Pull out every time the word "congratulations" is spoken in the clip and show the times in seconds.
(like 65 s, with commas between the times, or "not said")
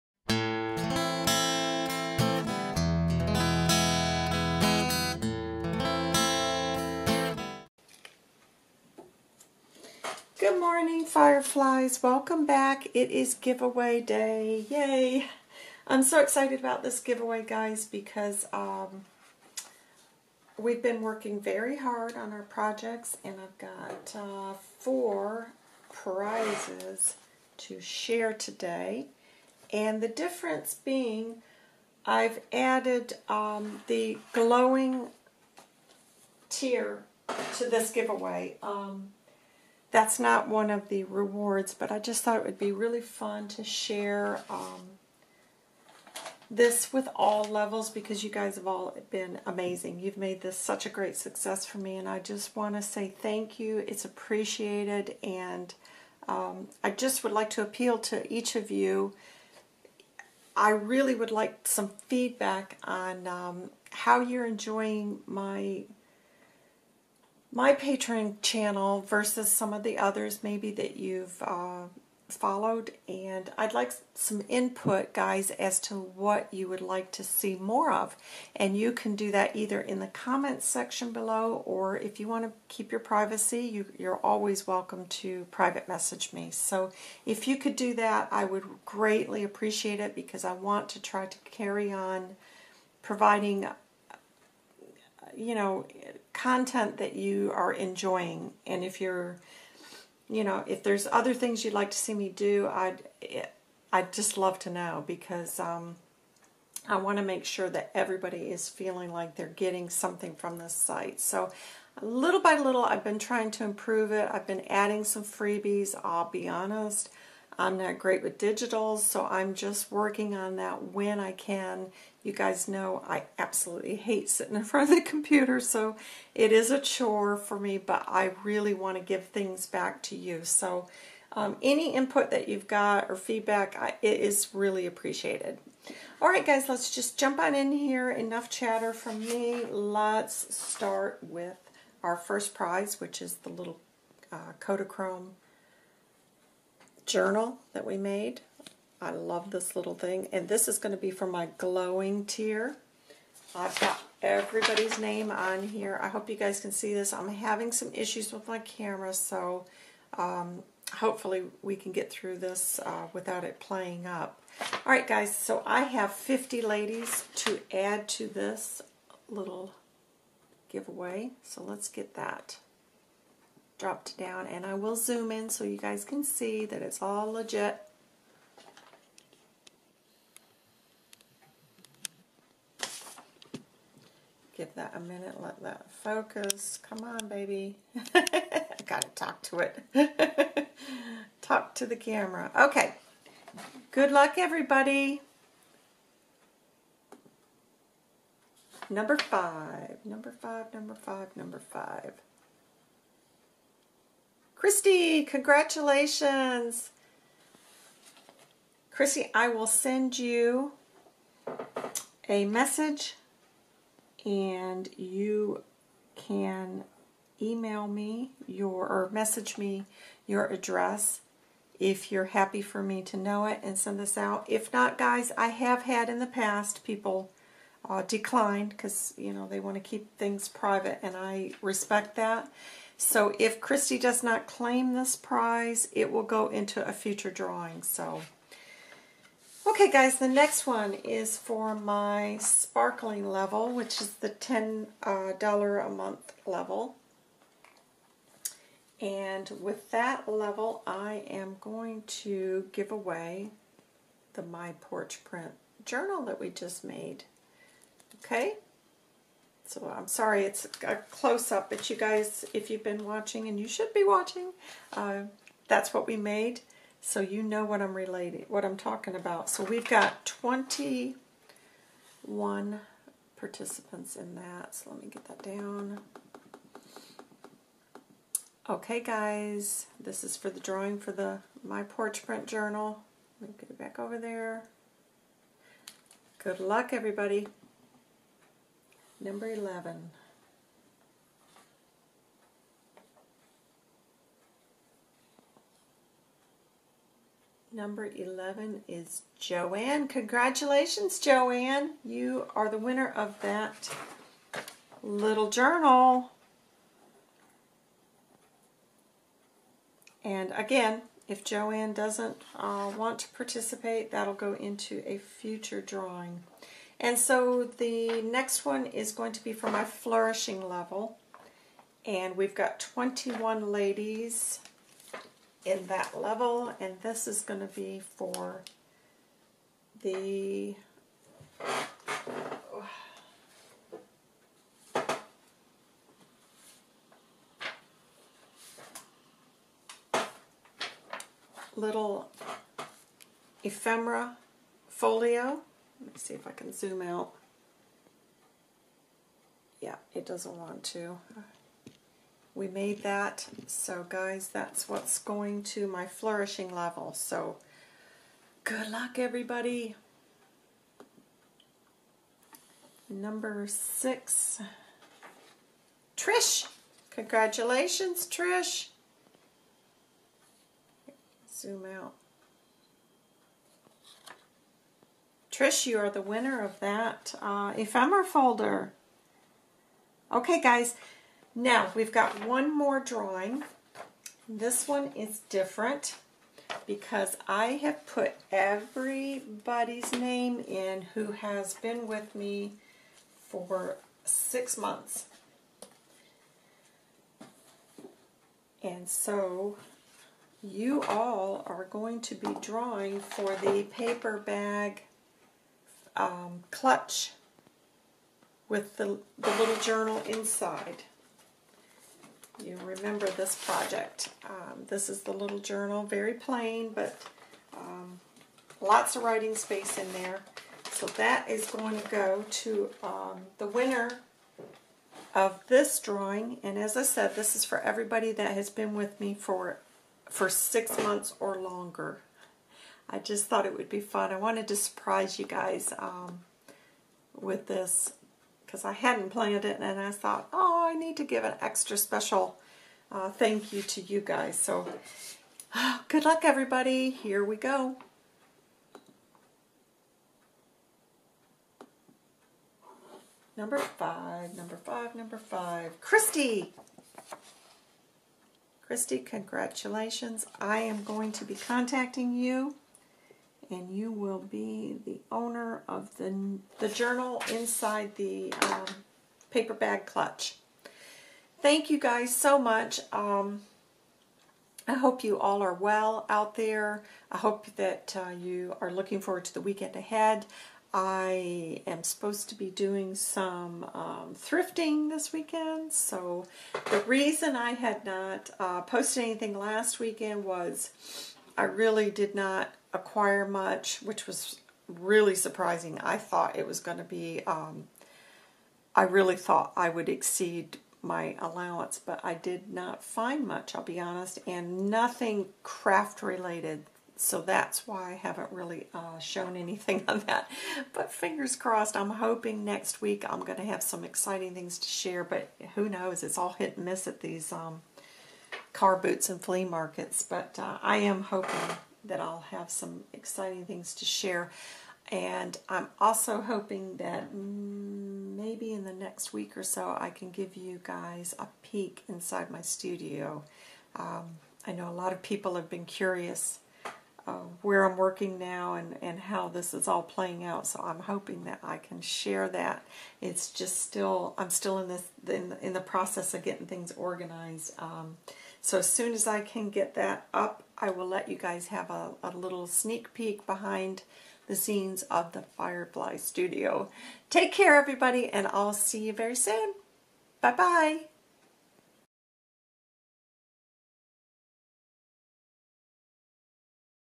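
205 s, 300 s, 367 s, 459 s.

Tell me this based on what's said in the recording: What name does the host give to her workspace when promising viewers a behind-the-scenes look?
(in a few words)
Firefly Studio.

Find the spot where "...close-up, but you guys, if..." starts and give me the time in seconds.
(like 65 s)
260 s.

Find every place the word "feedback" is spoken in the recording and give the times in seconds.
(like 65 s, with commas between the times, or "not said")
62 s, 133 s.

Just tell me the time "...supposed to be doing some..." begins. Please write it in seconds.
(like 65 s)
482 s.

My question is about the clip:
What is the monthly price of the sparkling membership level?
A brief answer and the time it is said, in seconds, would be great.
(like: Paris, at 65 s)
$10, at 244 s.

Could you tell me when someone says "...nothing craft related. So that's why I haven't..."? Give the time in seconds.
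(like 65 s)
504 s.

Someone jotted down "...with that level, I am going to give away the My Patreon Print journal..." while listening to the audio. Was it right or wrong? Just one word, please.
wrong.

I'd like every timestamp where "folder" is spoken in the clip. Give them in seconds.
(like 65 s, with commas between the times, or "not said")
378 s.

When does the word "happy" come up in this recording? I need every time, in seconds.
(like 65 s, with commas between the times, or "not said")
222 s.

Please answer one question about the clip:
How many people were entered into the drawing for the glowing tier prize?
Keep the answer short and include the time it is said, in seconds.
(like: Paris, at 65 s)
50, at 166 s.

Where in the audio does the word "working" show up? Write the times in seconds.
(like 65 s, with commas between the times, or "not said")
21 s, 119 s, 537 s.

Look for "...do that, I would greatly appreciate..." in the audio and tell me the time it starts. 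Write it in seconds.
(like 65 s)
87 s.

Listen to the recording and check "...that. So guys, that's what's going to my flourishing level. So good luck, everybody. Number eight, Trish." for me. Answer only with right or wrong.
wrong.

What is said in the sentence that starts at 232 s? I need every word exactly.
So if Christy does not claim this prize, it will go into a future drawing.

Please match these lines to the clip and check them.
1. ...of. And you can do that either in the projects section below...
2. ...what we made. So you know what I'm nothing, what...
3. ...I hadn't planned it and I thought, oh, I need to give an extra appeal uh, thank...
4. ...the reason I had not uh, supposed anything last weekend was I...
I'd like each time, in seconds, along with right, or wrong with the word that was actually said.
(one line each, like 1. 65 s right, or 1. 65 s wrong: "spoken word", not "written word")
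1. 77 s wrong: "comments", not "projects"
2. 265 s wrong: "relating", not "nothing"
3. 438 s wrong: "special", not "appeal"
4. 486 s wrong: "posted", not "supposed".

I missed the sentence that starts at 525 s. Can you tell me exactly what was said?
And I'm also hoping that maybe in the next week or so I can give you guys a peek inside my studio.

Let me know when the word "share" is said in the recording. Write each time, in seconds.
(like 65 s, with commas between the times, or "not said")
27 s, 43 s, 514 s, 524 s, 542 s.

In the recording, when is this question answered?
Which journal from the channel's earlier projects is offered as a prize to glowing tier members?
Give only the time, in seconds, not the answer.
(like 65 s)
144 s.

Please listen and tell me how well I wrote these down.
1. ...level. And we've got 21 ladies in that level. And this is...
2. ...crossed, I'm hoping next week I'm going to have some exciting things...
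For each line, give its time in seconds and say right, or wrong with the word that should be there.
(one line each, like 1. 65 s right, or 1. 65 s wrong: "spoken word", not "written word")
1. 320 s right
2. 511 s right.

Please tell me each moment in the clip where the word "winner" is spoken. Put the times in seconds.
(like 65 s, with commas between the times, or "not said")
302 s, 376 s, 423 s.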